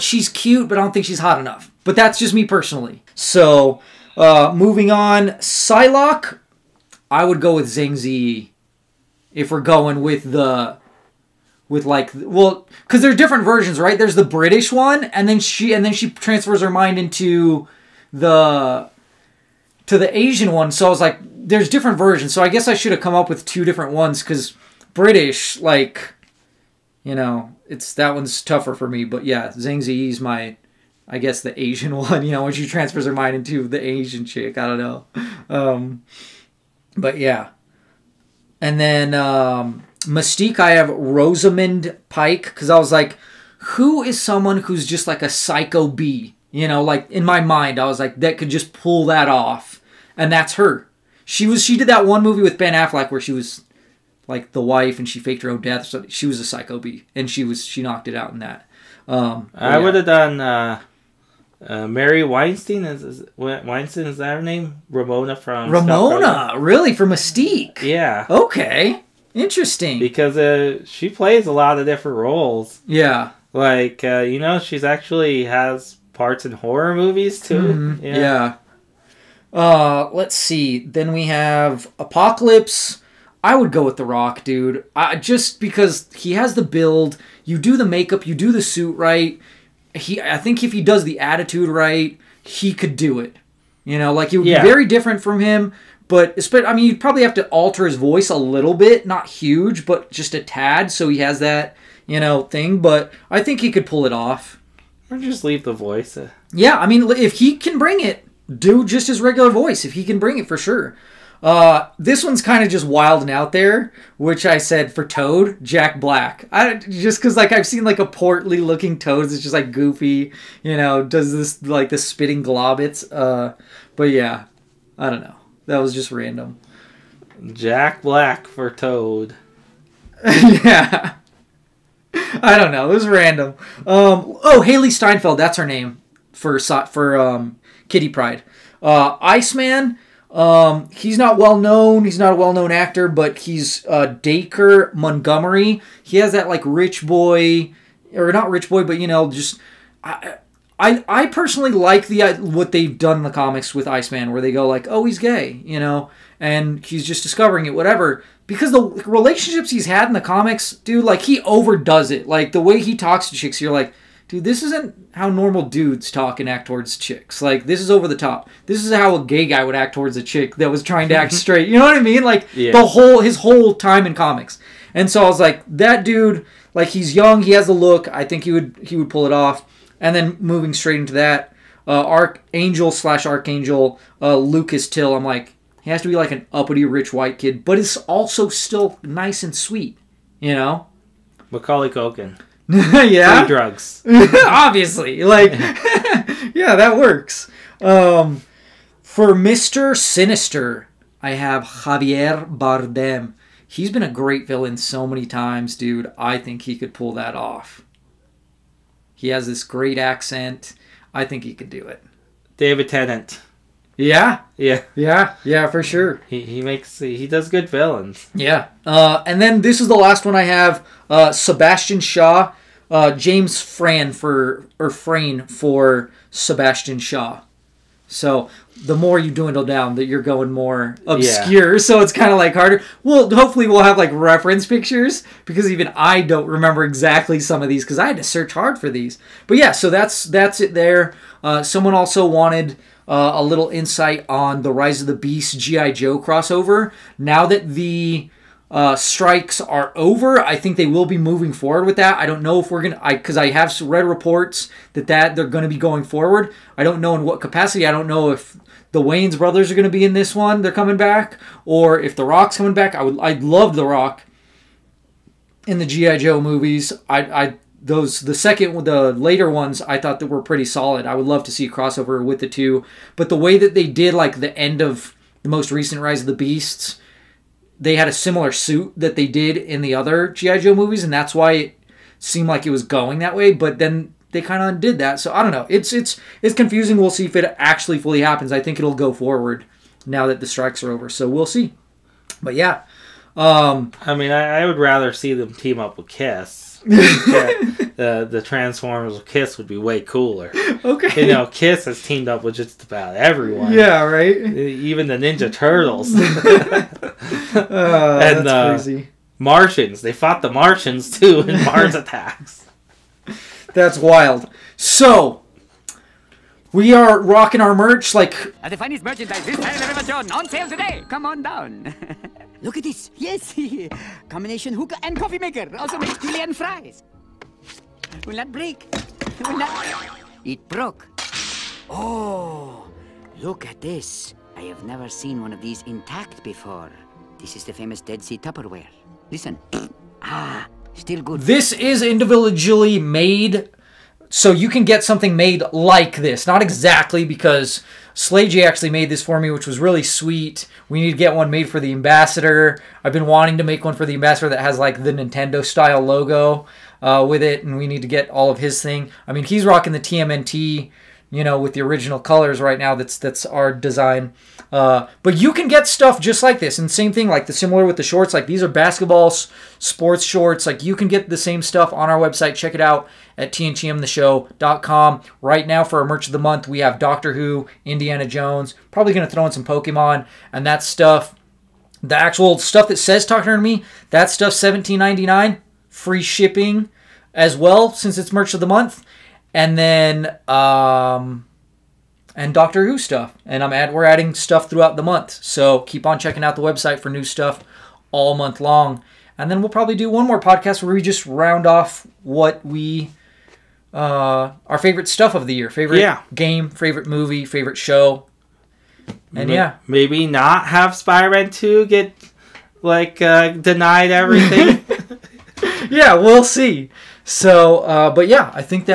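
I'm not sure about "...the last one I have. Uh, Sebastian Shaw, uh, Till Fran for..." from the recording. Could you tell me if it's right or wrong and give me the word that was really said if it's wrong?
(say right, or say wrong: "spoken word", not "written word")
wrong: "James", not "Till".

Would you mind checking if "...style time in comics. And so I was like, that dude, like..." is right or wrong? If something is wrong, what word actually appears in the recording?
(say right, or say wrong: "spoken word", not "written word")
wrong: "whole", not "style".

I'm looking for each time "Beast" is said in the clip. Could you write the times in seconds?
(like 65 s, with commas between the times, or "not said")
245 s, 276 s.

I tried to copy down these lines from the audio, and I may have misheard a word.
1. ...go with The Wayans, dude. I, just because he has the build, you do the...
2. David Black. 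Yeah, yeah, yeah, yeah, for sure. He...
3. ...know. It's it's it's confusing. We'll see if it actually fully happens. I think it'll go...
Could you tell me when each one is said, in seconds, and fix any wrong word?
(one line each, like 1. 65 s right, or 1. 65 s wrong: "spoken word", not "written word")
1. 83 s wrong: "Rock", not "Wayans"
2. 212 s wrong: "Tennant", not "Black"
3. 285 s right.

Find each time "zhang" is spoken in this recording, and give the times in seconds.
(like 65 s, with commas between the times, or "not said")
7 s, 29 s.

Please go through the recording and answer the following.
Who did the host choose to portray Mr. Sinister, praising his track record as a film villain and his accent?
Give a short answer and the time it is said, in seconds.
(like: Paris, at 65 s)
Javier Bardem, at 201 s.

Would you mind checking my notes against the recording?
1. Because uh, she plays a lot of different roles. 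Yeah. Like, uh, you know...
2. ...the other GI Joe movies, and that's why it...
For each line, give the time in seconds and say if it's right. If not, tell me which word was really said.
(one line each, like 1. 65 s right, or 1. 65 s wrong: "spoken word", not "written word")
1. 69 s right
2. 279 s right.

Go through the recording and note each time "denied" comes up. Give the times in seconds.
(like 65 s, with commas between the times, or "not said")
413 s.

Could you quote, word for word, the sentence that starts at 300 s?
Okay, you know, Kiss has teamed up with just about everyone.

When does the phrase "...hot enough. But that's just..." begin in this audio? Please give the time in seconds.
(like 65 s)
1 s.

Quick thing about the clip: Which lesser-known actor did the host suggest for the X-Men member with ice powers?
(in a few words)
Dacre Montgomery.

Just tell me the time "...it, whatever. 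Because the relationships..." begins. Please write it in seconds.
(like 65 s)
157 s.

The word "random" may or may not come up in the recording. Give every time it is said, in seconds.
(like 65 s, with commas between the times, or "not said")
126 s, 133 s.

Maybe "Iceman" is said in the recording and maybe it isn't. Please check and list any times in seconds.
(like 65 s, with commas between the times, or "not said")
139 s, 153 s.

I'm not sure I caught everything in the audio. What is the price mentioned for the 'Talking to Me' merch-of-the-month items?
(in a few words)
$17.99.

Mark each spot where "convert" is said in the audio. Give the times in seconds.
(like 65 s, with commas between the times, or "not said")
not said.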